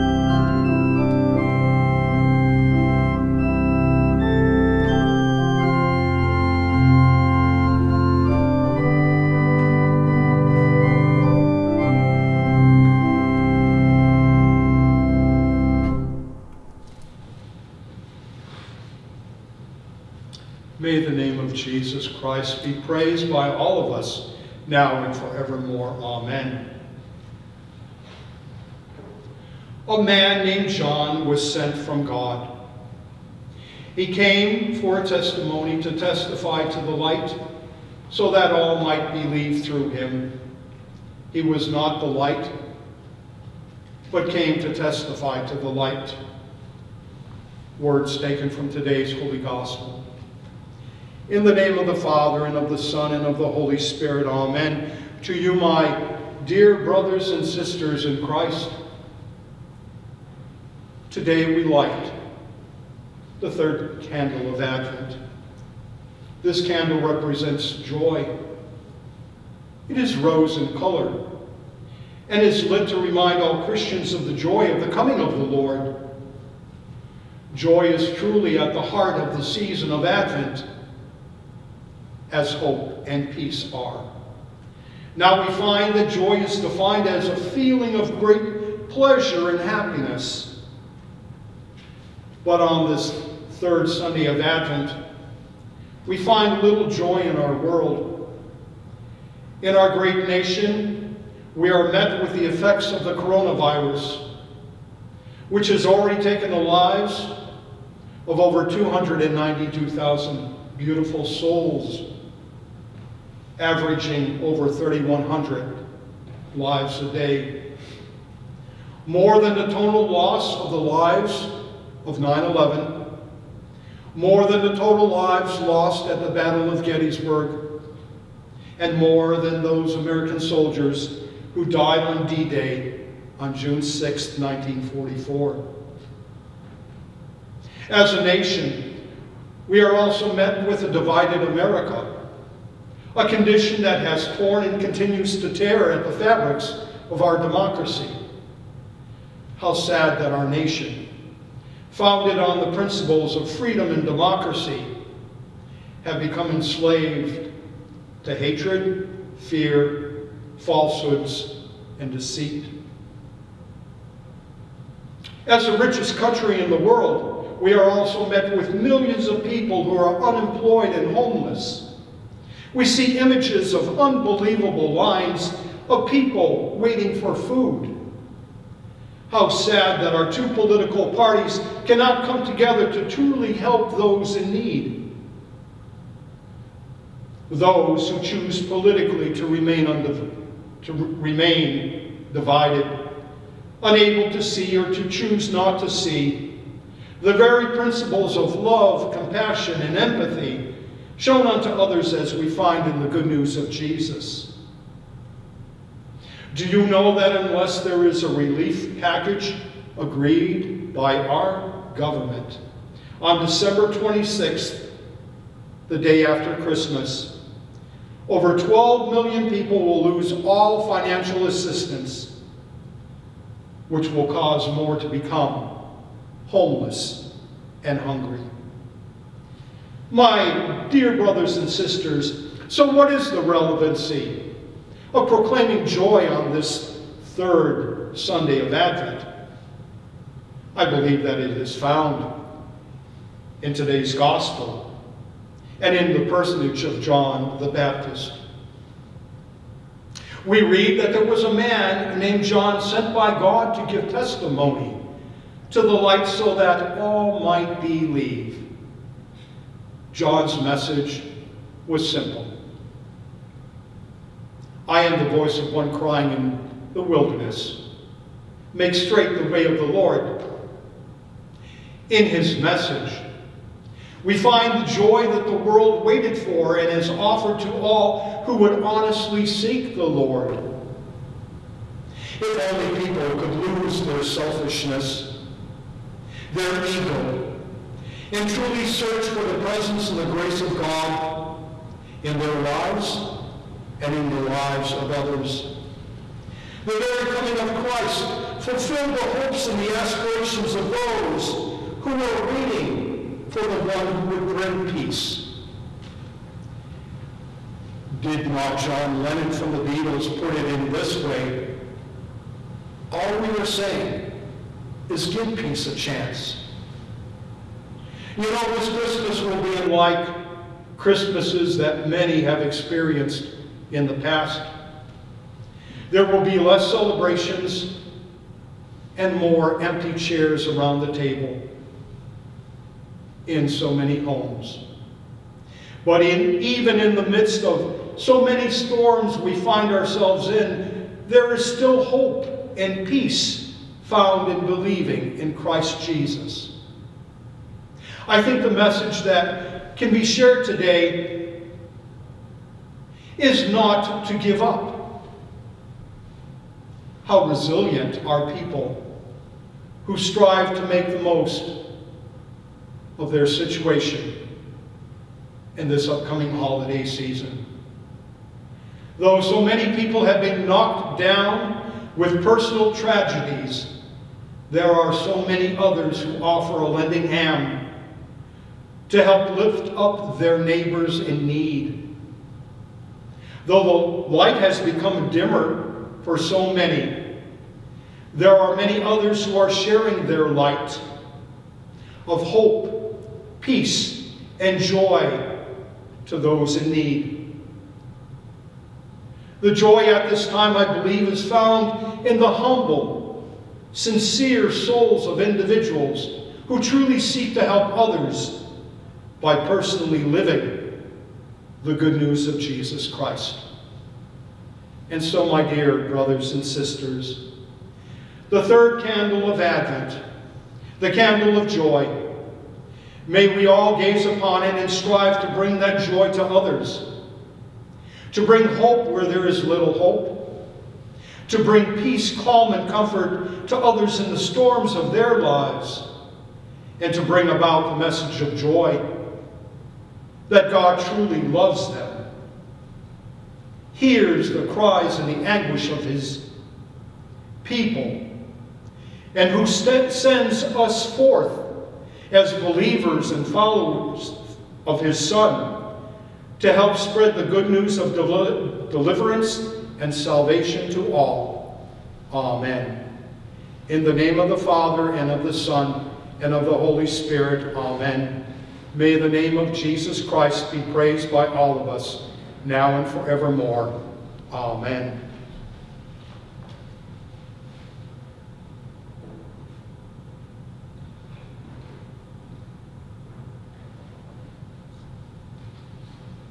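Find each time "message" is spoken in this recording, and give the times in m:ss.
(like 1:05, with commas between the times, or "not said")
4:20, 4:32, 5:48, 7:17.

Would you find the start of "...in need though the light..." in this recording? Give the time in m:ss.
6:21.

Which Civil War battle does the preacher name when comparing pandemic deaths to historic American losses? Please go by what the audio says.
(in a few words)
Gettysburg.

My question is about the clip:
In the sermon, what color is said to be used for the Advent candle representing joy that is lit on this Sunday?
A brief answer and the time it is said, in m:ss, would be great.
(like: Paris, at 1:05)
Rose, at 1:10.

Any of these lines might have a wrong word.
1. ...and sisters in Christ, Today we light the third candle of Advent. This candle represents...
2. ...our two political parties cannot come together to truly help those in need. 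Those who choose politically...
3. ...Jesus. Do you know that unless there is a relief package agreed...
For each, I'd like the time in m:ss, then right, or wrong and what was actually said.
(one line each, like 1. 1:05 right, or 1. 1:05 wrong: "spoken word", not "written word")
1. 0:57 right
2. 3:00 right
3. 3:23 right.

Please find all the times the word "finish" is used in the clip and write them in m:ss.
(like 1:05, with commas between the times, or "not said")
not said.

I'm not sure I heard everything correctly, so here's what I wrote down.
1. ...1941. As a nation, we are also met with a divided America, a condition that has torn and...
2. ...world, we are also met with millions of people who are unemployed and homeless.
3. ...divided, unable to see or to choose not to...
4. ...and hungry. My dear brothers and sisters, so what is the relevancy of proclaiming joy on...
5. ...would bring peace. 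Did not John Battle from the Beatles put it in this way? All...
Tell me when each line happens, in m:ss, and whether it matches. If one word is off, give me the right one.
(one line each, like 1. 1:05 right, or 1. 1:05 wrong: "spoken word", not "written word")
1. 2:14 wrong: "1944", not "1941"
2. 2:46 right
3. 3:12 right
4. 3:47 right
5. 5:04 wrong: "Lennon", not "Battle".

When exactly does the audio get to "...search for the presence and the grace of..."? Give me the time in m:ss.
4:48.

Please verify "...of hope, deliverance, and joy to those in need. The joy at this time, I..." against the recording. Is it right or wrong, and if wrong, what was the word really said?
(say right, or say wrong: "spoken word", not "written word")
wrong: "peace", not "deliverance".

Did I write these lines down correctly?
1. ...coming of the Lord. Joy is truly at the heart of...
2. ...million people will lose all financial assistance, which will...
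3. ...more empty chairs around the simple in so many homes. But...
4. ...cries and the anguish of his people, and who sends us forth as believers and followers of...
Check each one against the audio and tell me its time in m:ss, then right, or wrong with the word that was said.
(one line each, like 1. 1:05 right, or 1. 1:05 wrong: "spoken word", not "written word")
1. 1:14 right
2. 3:39 right
3. 5:29 wrong: "table", not "simple"
4. 7:24 right.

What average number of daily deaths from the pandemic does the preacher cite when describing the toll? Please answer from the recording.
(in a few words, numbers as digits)
3,100.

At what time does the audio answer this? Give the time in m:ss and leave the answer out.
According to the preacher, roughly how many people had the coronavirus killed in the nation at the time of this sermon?
1:48.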